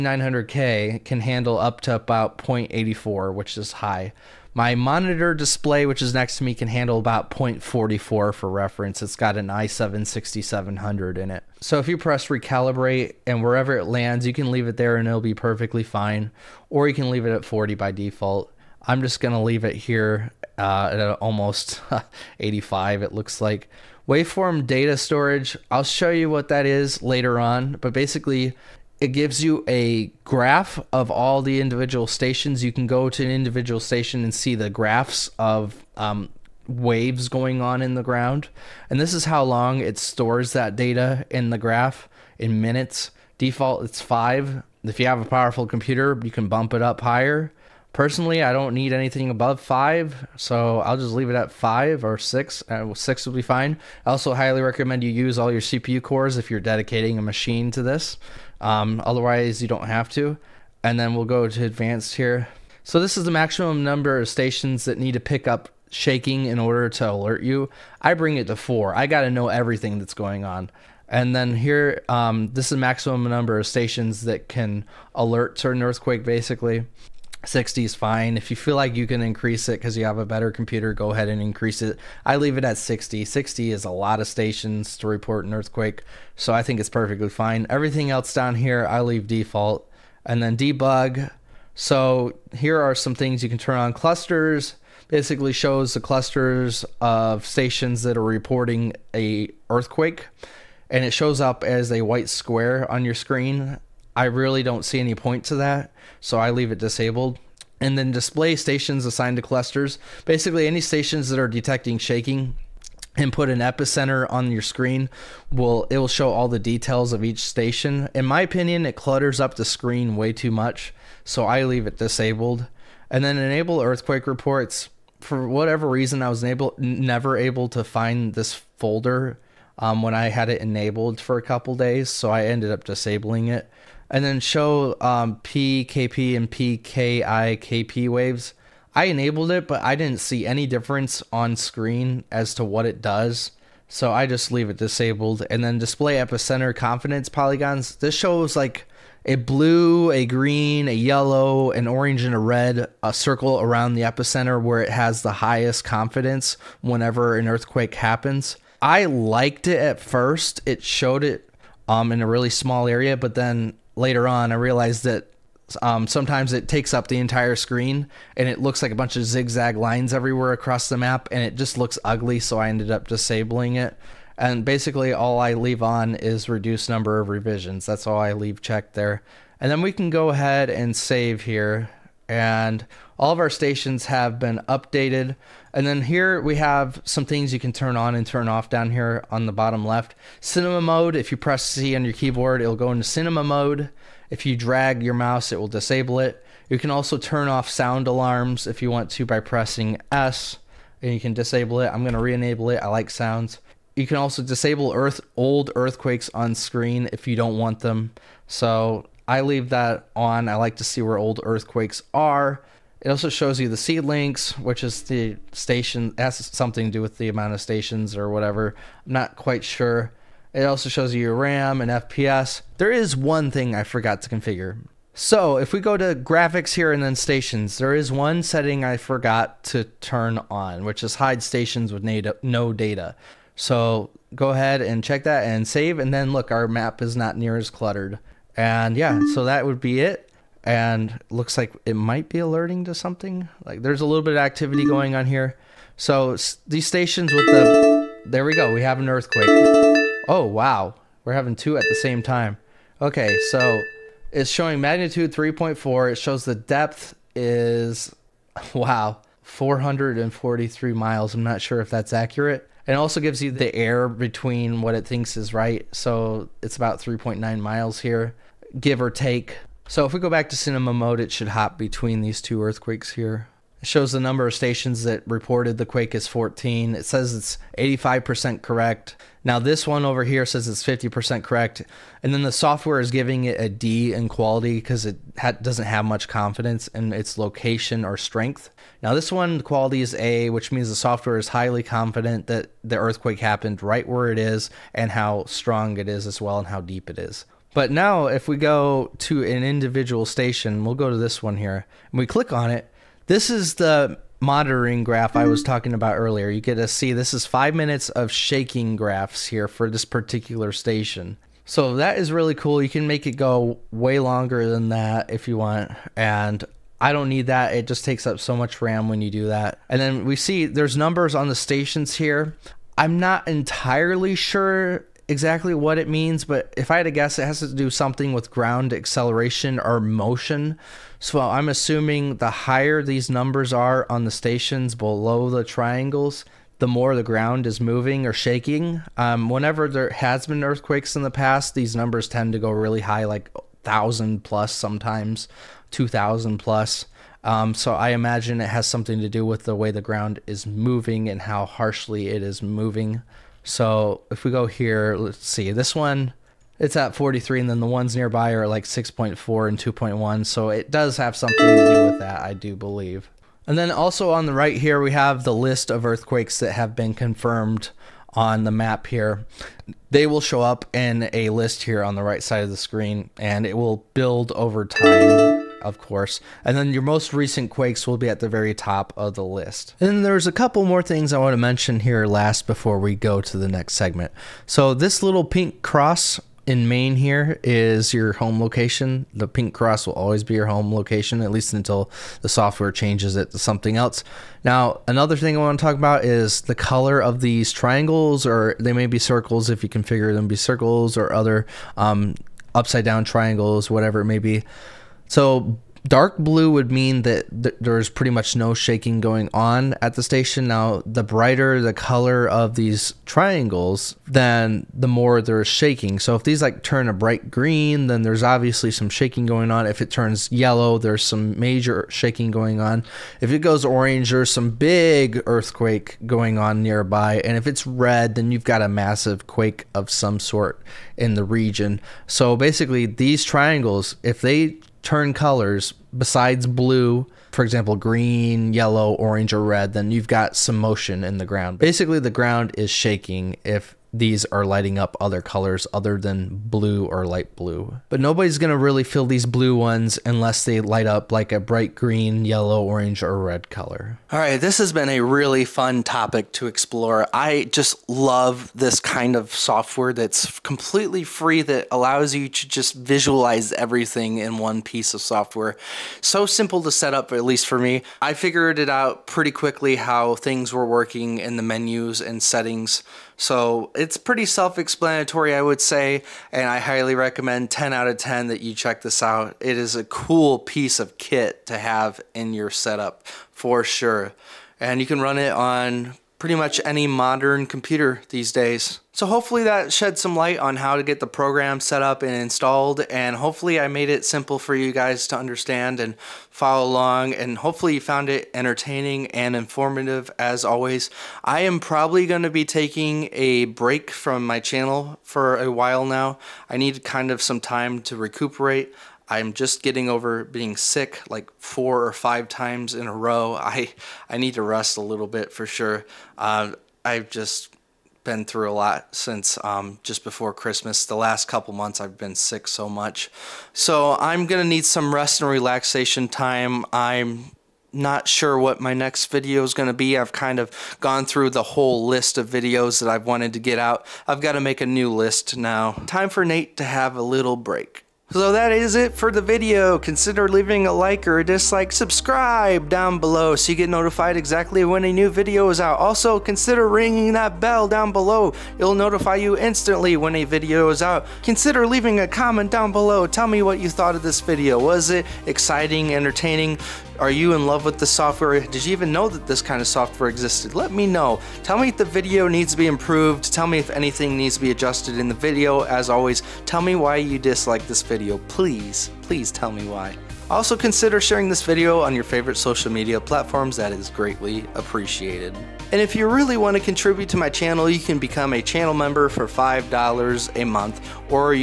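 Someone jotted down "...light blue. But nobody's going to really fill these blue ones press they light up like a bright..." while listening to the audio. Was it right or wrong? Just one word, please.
wrong.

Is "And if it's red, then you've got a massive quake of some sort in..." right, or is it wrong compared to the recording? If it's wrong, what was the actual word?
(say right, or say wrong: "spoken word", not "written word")
right.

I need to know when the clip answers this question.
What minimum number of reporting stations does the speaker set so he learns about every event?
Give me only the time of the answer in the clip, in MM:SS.
01:08.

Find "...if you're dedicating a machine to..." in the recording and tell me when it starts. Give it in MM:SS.
00:56.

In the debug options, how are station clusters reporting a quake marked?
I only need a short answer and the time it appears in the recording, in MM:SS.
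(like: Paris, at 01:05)
white square, at 01:42.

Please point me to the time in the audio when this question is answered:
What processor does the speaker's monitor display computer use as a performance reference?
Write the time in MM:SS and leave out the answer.
00:09.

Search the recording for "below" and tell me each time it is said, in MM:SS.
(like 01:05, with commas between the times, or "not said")
05:34, 09:03, 09:08, 09:12.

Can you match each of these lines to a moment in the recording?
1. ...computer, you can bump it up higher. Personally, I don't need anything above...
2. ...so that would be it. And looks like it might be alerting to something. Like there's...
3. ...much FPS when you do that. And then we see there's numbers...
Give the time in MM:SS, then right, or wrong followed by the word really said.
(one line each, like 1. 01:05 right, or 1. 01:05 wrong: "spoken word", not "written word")
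1. 00:45 right
2. 03:59 right
3. 05:18 wrong: "RAM", not "FPS".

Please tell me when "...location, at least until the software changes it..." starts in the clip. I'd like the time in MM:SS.
06:30.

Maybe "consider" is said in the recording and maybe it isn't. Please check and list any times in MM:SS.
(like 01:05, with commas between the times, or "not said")
08:59, 09:06, 09:11, 09:30.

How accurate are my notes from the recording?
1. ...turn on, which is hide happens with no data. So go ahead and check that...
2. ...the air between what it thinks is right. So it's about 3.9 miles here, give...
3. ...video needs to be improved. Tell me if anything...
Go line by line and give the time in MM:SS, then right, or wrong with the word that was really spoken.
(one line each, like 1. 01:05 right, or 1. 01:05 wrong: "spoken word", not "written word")
1. 03:49 wrong: "stations", not "happens"
2. 04:23 right
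3. 09:22 right.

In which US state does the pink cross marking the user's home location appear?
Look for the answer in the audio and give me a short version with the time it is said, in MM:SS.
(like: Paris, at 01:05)
Maine, at 06:26.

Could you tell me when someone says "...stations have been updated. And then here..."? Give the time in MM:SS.
03:03.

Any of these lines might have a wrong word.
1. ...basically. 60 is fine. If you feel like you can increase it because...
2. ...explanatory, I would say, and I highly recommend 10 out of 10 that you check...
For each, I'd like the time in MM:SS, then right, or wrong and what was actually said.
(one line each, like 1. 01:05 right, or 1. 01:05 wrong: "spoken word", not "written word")
1. 01:16 right
2. 07:54 right.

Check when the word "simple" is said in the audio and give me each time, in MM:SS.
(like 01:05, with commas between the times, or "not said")
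07:46, 08:14.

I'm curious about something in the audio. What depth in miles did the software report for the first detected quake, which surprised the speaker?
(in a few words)
443 miles.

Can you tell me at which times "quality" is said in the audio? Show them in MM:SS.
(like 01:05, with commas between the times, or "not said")
04:44, 04:49.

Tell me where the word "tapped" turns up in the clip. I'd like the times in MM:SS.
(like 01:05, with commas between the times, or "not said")
not said.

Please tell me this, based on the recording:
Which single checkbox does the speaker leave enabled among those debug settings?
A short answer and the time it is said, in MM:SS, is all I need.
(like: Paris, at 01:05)
reduce number of revisions, at 02:56.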